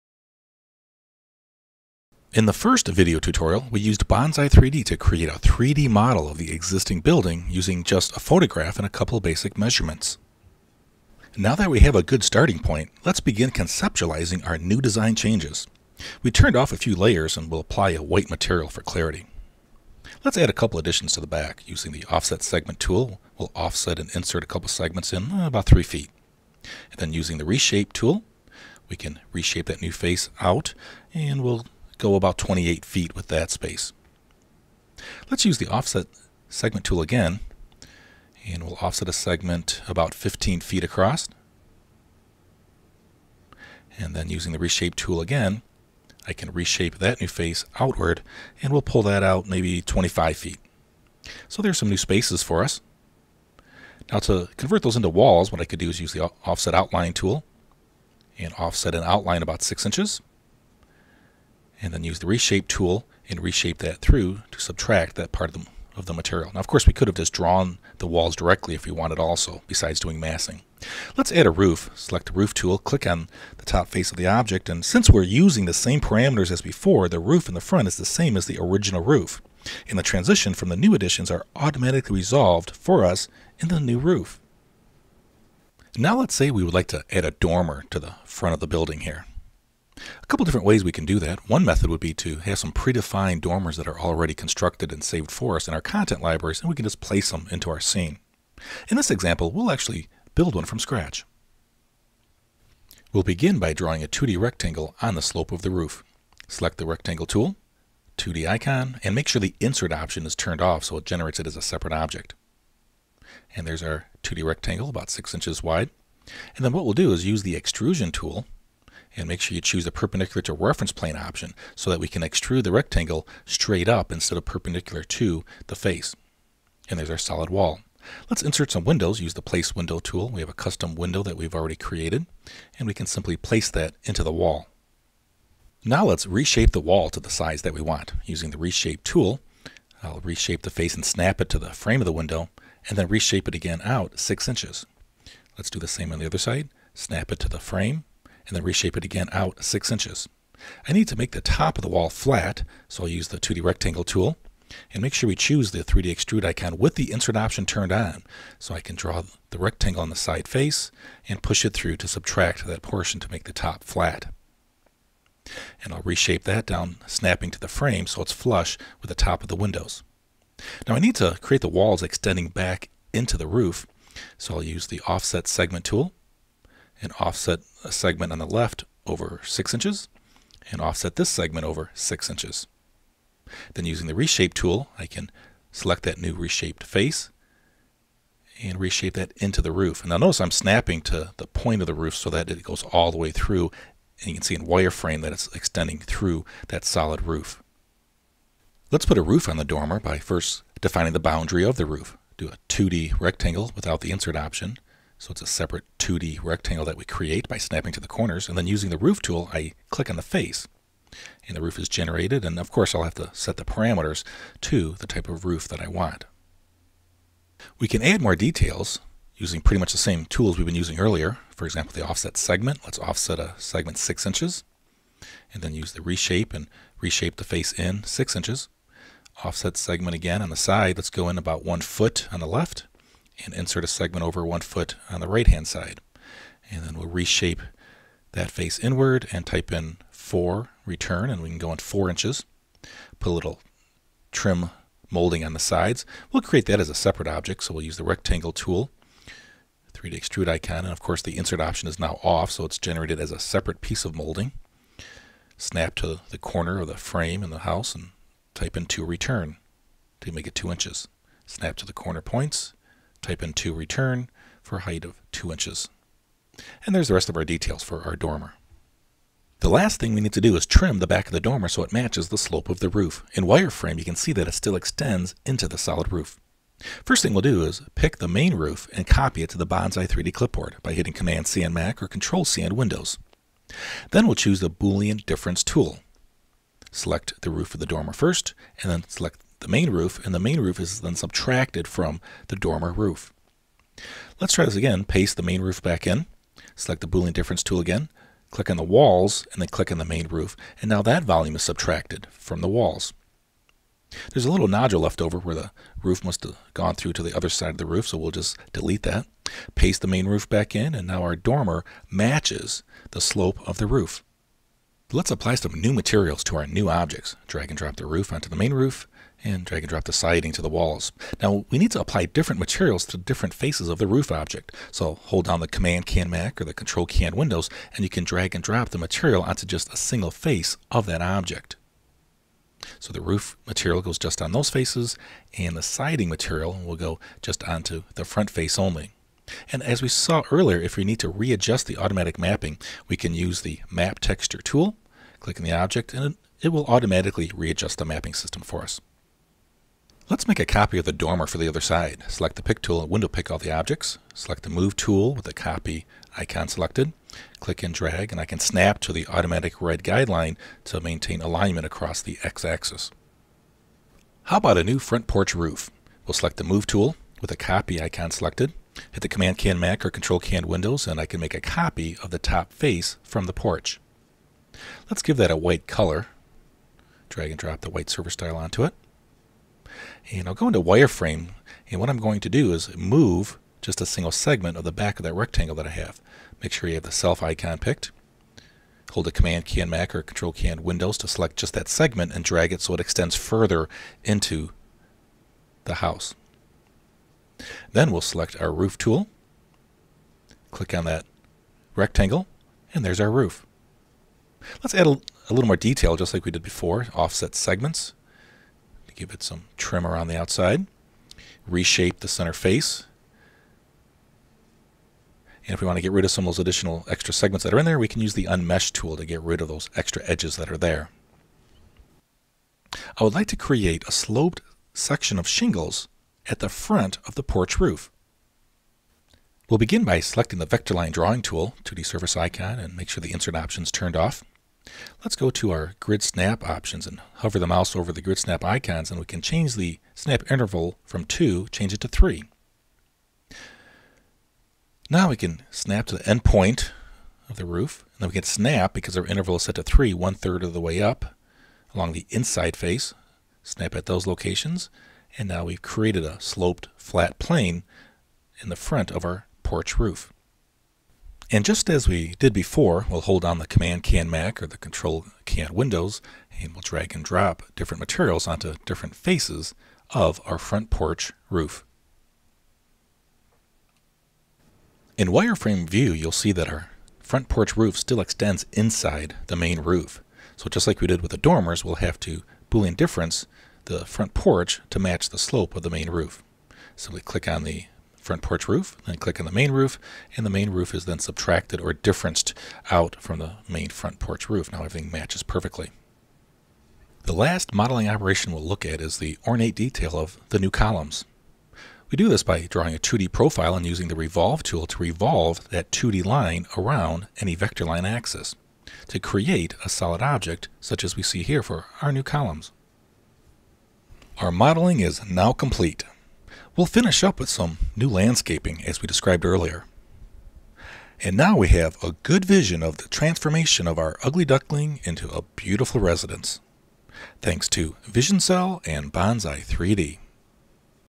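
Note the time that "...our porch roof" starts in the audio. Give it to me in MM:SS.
07:39.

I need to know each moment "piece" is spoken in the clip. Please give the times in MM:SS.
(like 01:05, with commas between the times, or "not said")
04:13.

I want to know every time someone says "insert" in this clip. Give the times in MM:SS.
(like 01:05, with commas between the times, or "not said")
00:24, 01:49, 02:08, 02:37, 03:24, 03:53, 04:11, 07:13.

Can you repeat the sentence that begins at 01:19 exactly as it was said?
And the transition from the new additions are automatically resolved for us in the new roof.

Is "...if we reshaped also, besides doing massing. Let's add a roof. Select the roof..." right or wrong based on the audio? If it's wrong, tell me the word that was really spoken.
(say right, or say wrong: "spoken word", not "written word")
wrong: "wanted", not "reshaped".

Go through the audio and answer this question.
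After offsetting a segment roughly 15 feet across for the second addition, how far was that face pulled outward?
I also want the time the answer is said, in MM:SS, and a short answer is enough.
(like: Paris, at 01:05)
25 feet, at 00:49.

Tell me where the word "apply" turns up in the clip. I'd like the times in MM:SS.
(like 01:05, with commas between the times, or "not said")
00:17, 05:15, 05:21.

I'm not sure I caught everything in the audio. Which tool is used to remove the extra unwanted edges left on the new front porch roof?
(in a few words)
unmesh tool.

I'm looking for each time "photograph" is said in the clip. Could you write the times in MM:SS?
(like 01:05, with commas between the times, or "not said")
00:08.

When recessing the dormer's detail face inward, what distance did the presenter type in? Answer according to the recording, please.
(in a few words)
4 inches.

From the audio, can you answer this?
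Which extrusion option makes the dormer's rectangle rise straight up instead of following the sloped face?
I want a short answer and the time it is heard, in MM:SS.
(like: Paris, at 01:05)
perpendicular to reference plane, at 01:59.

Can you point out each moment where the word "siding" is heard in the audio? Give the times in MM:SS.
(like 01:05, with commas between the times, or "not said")
05:20, 05:35.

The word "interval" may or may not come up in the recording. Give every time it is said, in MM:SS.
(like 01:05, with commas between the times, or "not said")
07:20, 07:29.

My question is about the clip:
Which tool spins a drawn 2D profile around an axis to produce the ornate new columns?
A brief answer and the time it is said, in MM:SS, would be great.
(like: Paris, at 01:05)
Revolve tool, at 08:24.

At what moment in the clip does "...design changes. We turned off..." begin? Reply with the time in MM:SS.
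00:14.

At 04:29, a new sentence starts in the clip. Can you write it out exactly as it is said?
The last thing we need to do is trim the back of the dormer so it matches the slope of the roof.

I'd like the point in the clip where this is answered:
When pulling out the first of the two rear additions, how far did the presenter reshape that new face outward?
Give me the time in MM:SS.
00:32.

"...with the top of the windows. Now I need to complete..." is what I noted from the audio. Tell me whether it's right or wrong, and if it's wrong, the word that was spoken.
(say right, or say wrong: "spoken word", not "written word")
wrong: "create", not "complete".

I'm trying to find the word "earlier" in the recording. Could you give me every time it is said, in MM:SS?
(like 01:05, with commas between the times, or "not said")
03:40, 05:40, 08:39.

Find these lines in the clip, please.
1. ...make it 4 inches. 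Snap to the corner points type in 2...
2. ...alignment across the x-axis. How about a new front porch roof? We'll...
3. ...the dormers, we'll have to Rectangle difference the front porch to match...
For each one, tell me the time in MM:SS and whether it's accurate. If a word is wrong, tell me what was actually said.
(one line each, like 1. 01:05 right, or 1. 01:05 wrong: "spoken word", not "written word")
1. 04:20 wrong: "2", not "4"
2. 06:01 right
3. 08:01 wrong: "Boolean", not "Rectangle".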